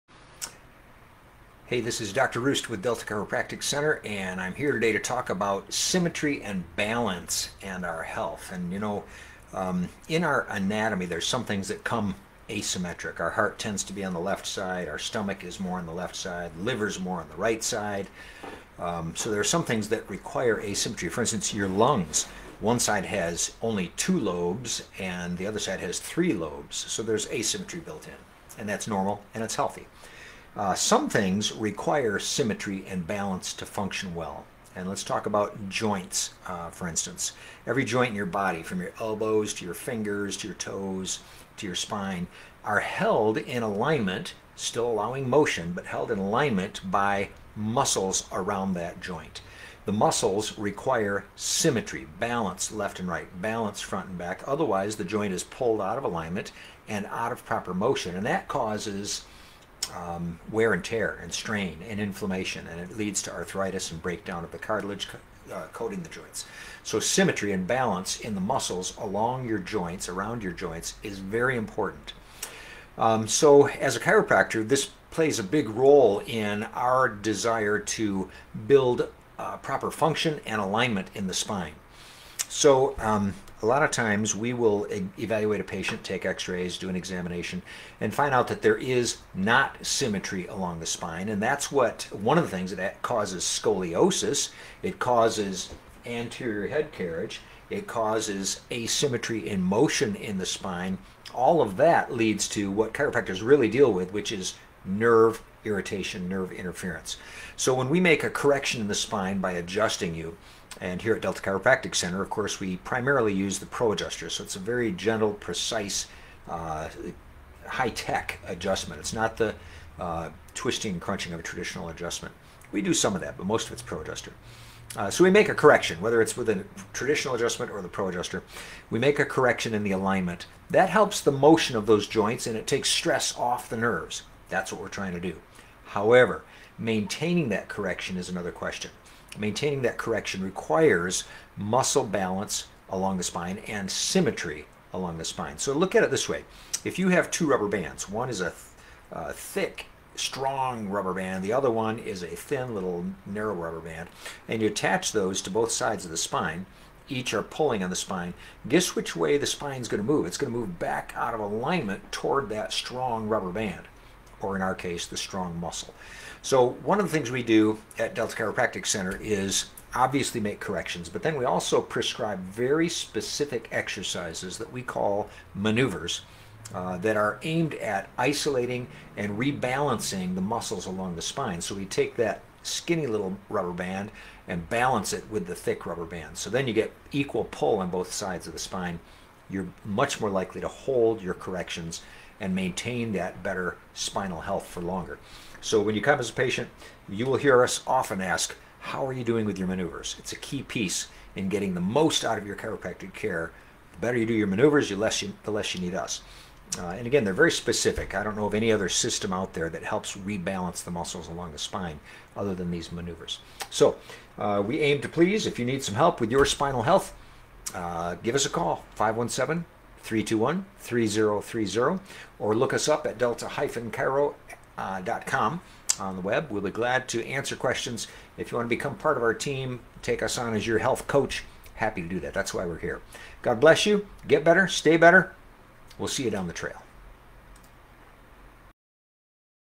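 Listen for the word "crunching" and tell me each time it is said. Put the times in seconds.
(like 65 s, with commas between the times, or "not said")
121 s.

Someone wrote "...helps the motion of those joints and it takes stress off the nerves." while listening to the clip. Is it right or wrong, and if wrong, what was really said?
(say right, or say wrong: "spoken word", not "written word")
right.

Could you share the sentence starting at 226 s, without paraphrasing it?
We'll be glad to answer questions.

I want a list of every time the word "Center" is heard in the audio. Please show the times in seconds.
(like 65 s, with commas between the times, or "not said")
3 s, 111 s, 168 s.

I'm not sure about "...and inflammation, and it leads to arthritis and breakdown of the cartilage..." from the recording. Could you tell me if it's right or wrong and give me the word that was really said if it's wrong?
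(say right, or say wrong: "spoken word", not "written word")
right.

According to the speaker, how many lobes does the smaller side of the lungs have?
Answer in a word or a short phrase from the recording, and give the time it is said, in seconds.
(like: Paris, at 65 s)
2, at 23 s.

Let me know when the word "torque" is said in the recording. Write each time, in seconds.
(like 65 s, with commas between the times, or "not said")
not said.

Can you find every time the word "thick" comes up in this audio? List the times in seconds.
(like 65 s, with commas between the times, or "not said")
149 s, 185 s.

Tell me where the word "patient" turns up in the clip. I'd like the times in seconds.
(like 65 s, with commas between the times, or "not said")
85 s, 196 s.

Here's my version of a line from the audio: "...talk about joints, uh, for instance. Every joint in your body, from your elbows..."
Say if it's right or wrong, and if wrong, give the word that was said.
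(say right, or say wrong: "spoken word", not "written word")
right.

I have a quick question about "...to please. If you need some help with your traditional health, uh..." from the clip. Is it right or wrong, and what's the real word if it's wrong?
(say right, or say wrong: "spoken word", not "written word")
wrong: "spinal", not "traditional".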